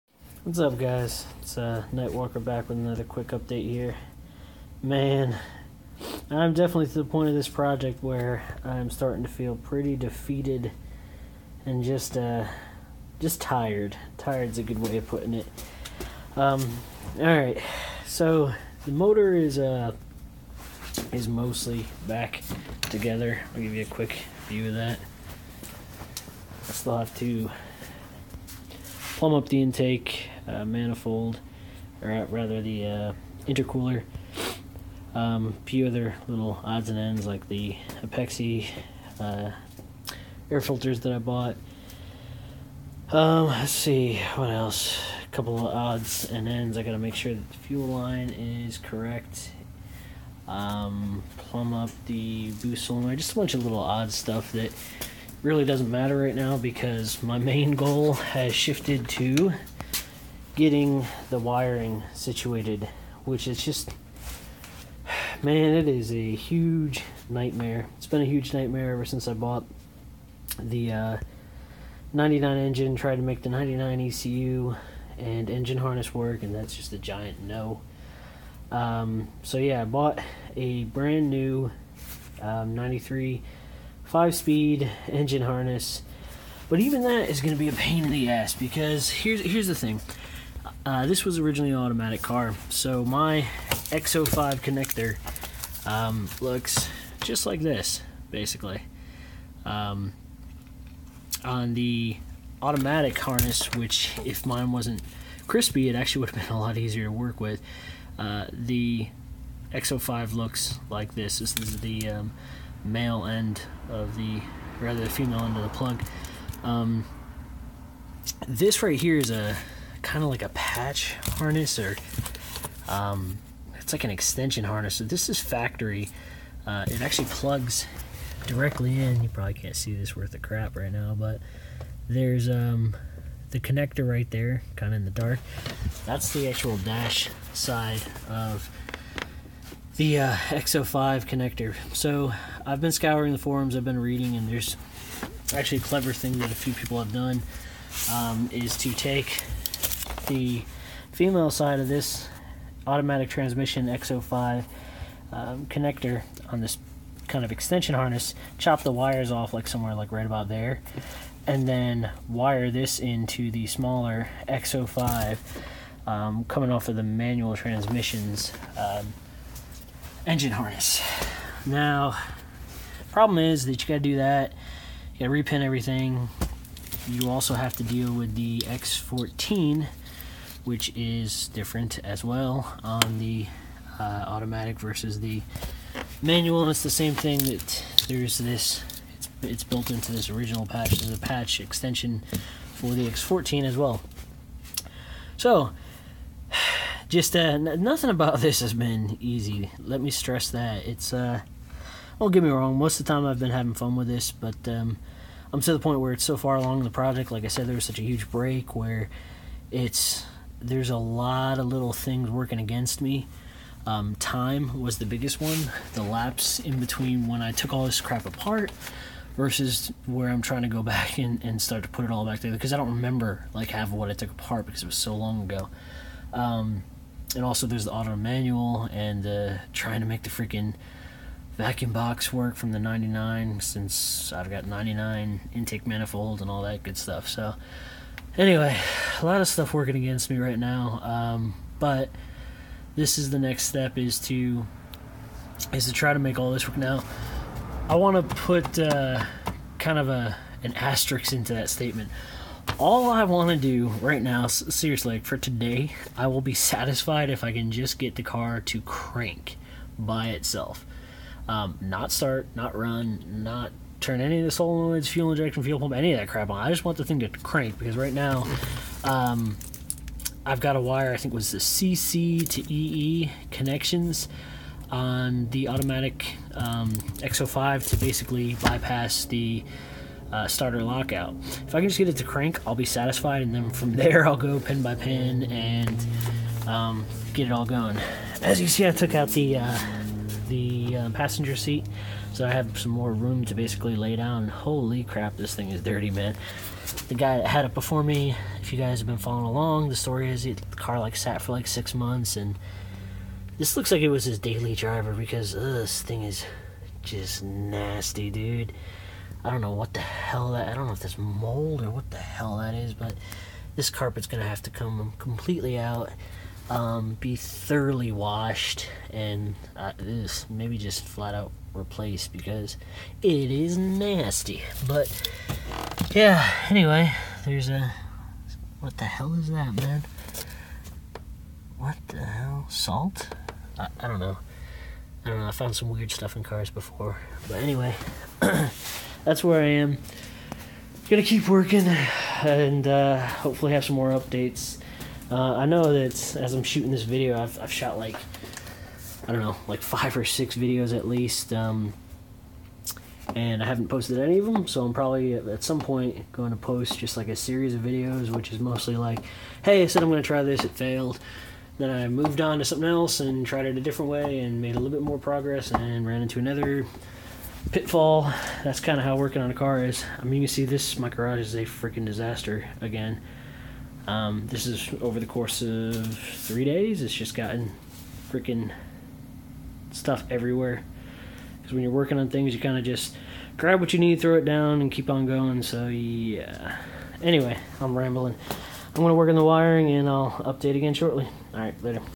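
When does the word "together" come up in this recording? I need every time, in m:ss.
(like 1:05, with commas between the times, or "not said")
0:22, 3:42.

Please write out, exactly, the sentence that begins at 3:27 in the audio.
Like I said, there was such a huge break where it's there's a lot of little things working against me.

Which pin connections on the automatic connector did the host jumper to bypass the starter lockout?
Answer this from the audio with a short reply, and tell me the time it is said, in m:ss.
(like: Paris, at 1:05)
CC to EE, at 4:31.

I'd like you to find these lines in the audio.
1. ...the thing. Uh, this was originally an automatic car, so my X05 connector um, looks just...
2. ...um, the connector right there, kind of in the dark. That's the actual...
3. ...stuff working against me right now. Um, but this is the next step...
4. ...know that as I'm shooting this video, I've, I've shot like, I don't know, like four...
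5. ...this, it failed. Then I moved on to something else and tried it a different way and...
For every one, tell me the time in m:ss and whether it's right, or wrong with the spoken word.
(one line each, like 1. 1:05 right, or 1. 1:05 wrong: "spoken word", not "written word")
1. 1:29 right
2. 2:12 right
3. 3:59 right
4. 5:45 wrong: "five", not "four"
5. 6:00 right.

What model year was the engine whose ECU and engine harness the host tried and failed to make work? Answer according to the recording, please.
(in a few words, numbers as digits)
99.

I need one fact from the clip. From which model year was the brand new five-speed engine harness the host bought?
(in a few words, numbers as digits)
93.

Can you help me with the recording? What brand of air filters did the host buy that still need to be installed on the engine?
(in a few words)
Apexi.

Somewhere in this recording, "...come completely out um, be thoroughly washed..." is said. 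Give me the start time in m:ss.
5:14.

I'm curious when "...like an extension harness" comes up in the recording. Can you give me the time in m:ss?
2:03.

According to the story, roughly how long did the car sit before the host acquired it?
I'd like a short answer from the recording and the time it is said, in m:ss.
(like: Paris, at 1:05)
6 months, at 5:01.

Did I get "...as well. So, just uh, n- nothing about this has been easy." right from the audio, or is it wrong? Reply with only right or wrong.
right.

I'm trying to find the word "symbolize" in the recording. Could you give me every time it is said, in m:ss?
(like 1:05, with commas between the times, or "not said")
not said.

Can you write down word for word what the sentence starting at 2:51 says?
Now, problem is that you got to do that.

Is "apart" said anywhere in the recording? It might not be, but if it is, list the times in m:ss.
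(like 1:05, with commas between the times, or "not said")
3:38, 3:44.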